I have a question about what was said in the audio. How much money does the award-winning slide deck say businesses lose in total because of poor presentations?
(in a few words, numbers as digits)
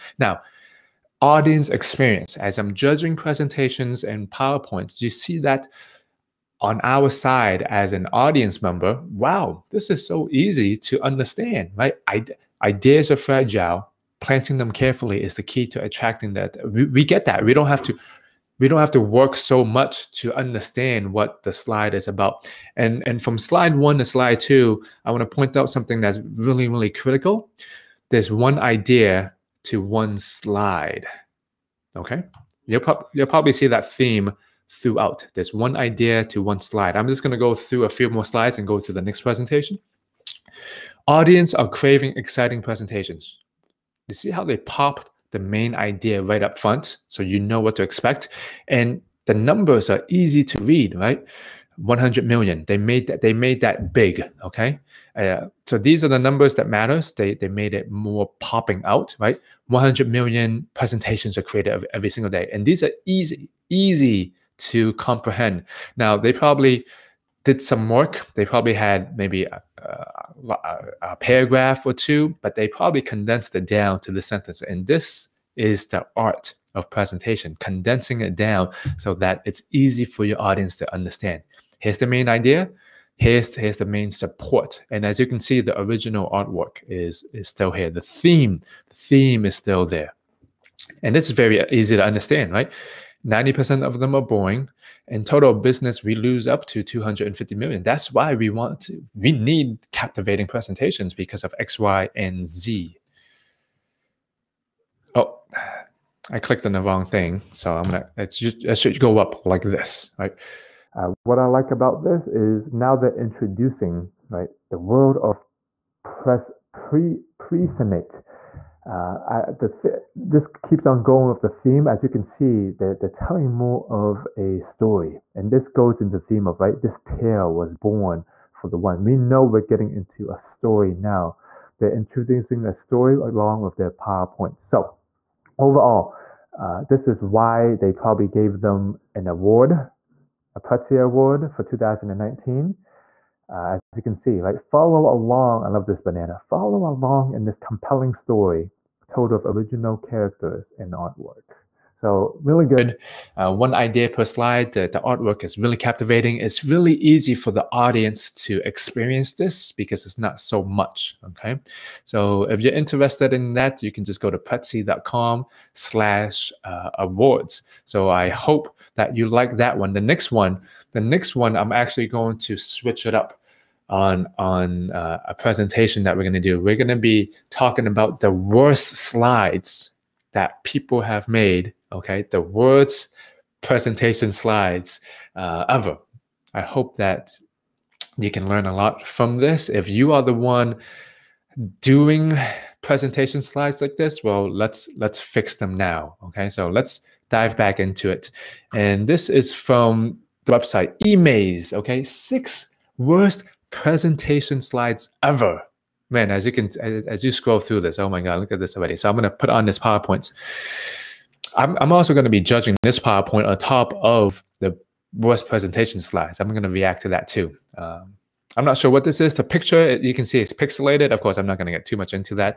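250 million.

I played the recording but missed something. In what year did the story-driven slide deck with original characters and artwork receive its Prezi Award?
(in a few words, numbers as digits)
2019.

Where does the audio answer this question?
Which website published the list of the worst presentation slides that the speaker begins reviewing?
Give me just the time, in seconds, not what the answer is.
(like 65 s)
201 s.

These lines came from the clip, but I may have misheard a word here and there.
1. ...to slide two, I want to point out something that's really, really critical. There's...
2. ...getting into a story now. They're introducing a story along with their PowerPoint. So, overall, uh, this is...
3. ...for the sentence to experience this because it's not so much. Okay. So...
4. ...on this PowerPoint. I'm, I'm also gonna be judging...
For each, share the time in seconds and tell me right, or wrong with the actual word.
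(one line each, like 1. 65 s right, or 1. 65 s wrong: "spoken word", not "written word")
1. 23 s right
2. 129 s right
3. 157 s wrong: "audience", not "sentence"
4. 209 s right.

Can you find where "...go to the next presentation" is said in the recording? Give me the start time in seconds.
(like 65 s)
38 s.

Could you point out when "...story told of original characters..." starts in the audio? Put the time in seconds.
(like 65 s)
148 s.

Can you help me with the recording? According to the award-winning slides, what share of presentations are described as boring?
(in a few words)
90%.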